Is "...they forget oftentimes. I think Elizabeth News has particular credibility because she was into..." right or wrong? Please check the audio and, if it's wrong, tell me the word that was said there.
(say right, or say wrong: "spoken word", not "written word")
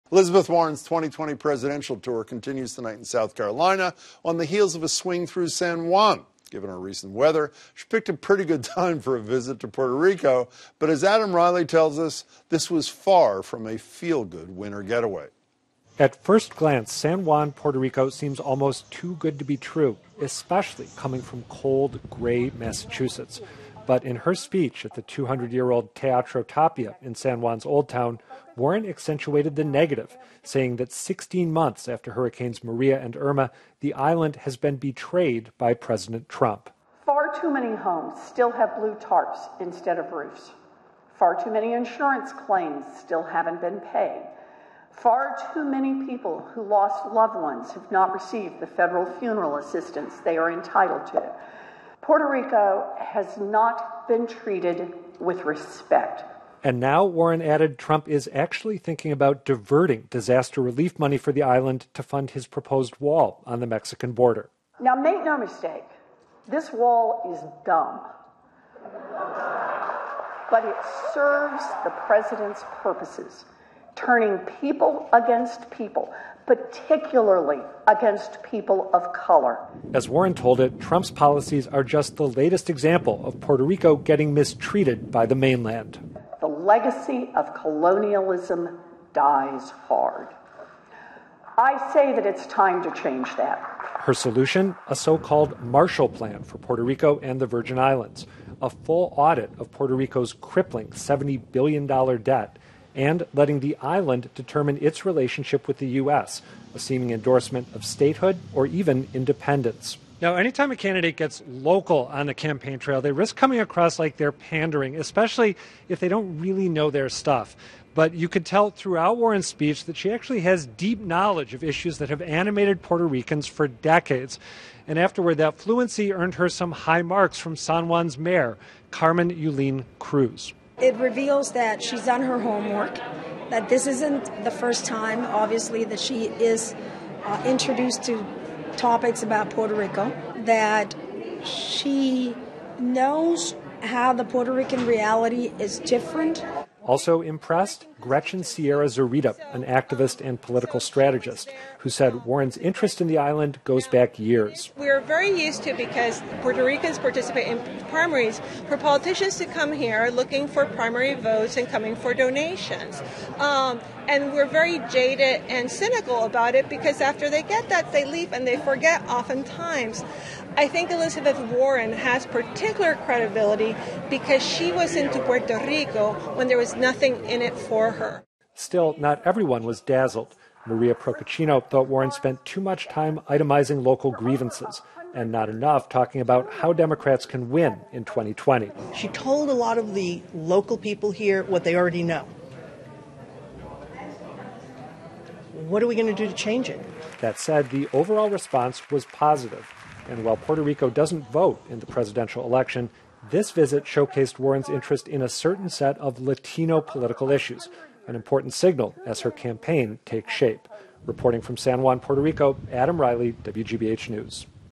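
wrong: "Warren", not "News".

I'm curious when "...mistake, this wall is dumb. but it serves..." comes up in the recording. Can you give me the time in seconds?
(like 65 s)
65 s.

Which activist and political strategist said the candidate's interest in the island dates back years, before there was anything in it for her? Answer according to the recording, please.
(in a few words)
Gretchen Sierra Zorita.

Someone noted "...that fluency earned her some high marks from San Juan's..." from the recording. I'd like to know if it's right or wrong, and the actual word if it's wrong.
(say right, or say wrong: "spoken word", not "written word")
right.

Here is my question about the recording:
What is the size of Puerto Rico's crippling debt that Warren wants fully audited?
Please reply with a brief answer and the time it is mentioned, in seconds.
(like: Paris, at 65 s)
$70 billion, at 100 s.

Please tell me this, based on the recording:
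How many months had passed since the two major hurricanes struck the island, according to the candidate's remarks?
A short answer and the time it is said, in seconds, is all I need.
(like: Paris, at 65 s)
16, at 30 s.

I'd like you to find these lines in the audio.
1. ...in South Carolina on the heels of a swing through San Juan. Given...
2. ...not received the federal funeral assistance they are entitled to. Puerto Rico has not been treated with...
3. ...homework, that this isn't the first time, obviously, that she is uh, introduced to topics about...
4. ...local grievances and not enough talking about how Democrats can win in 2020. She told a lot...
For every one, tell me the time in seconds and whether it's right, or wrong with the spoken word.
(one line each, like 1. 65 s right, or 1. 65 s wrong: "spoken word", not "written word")
1. 2 s right
2. 47 s right
3. 132 s right
4. 183 s right.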